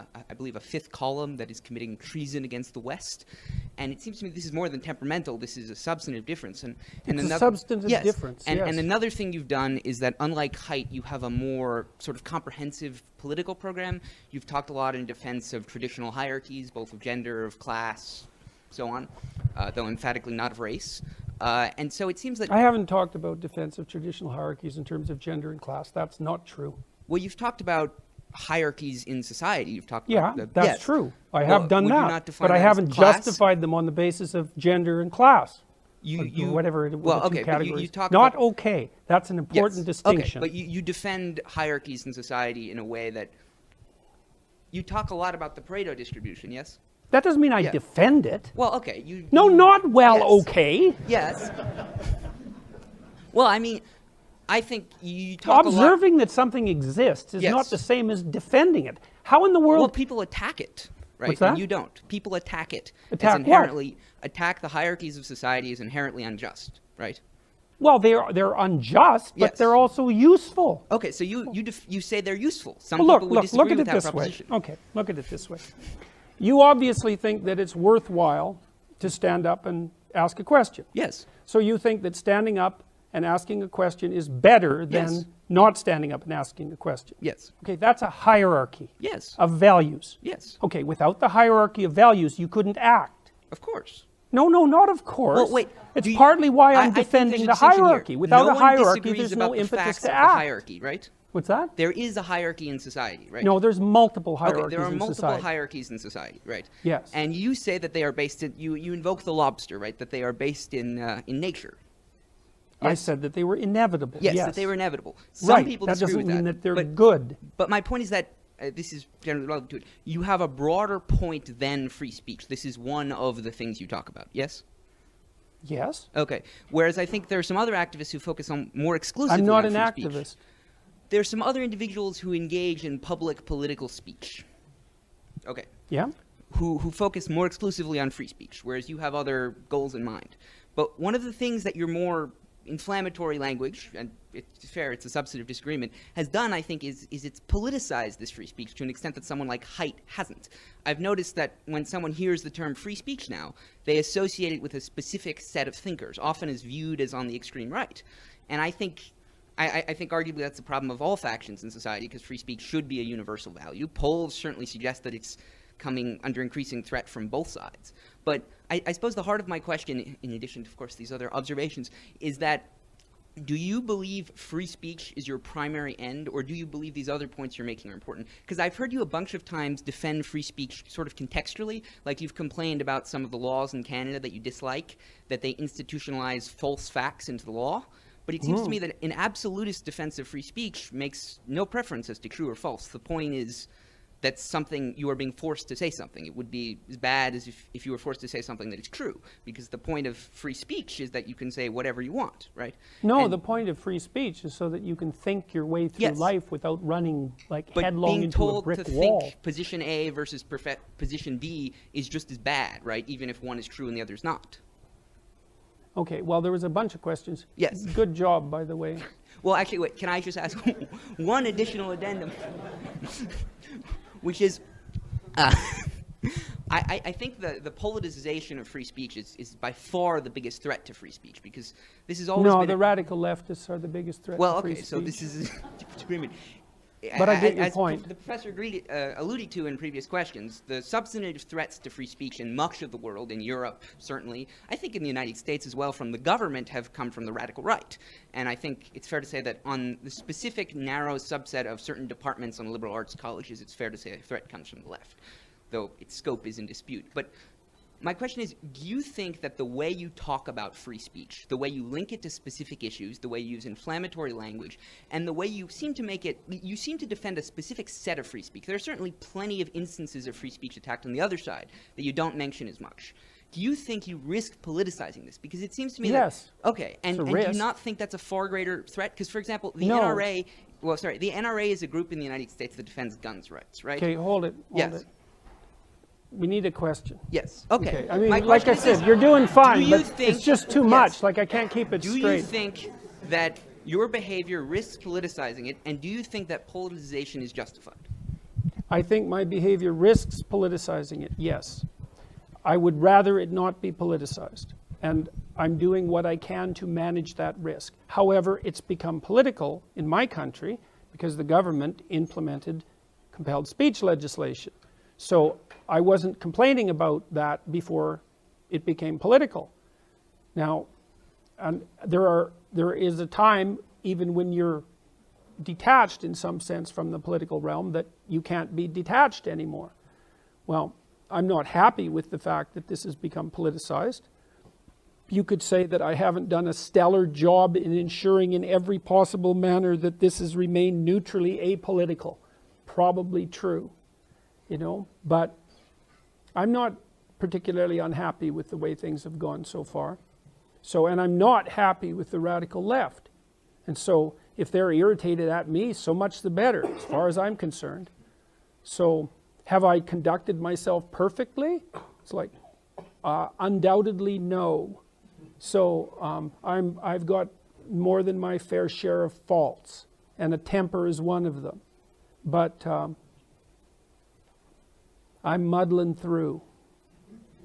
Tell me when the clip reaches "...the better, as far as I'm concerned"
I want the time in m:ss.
5:56.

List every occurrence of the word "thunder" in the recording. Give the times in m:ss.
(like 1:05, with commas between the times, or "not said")
not said.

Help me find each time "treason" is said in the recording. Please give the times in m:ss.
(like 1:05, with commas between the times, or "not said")
0:01.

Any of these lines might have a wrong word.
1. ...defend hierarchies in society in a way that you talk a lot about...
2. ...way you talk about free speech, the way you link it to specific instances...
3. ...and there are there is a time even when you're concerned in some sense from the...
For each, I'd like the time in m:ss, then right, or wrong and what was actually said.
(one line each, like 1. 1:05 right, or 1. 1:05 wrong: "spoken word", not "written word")
1. 0:40 right
2. 4:19 wrong: "issues", not "instances"
3. 5:21 wrong: "detached", not "concerned".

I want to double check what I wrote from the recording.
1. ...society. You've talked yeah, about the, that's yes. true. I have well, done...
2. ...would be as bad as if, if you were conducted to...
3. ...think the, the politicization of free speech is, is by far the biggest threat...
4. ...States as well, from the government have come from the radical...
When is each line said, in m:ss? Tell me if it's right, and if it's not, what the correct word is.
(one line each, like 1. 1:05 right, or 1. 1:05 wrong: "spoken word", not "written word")
1. 0:29 right
2. 3:16 wrong: "forced", not "conducted"
3. 3:47 right
4. 4:05 right.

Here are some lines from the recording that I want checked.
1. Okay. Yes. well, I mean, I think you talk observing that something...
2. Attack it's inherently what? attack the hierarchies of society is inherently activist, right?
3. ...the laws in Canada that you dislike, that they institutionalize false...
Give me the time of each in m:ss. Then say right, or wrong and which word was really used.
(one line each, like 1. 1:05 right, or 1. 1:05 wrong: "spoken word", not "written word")
1. 0:50 right
2. 1:03 wrong: "unjust", not "activist"
3. 3:03 right.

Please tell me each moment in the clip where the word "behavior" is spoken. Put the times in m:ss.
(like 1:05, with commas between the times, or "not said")
4:54, 4:59.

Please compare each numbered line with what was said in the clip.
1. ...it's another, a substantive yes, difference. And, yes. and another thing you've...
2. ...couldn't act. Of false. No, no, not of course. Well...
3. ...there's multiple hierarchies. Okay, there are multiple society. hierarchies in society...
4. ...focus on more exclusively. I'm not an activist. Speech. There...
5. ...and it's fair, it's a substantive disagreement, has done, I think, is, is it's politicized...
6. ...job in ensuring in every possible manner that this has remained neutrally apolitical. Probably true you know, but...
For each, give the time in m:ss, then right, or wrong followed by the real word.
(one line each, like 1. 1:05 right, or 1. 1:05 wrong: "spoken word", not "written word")
1. 0:07 right
2. 1:32 wrong: "course", not "false"
3. 1:43 right
4. 2:08 right
5. 2:23 right
6. 5:37 right.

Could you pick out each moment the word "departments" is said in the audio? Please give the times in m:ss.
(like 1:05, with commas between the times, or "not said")
4:12.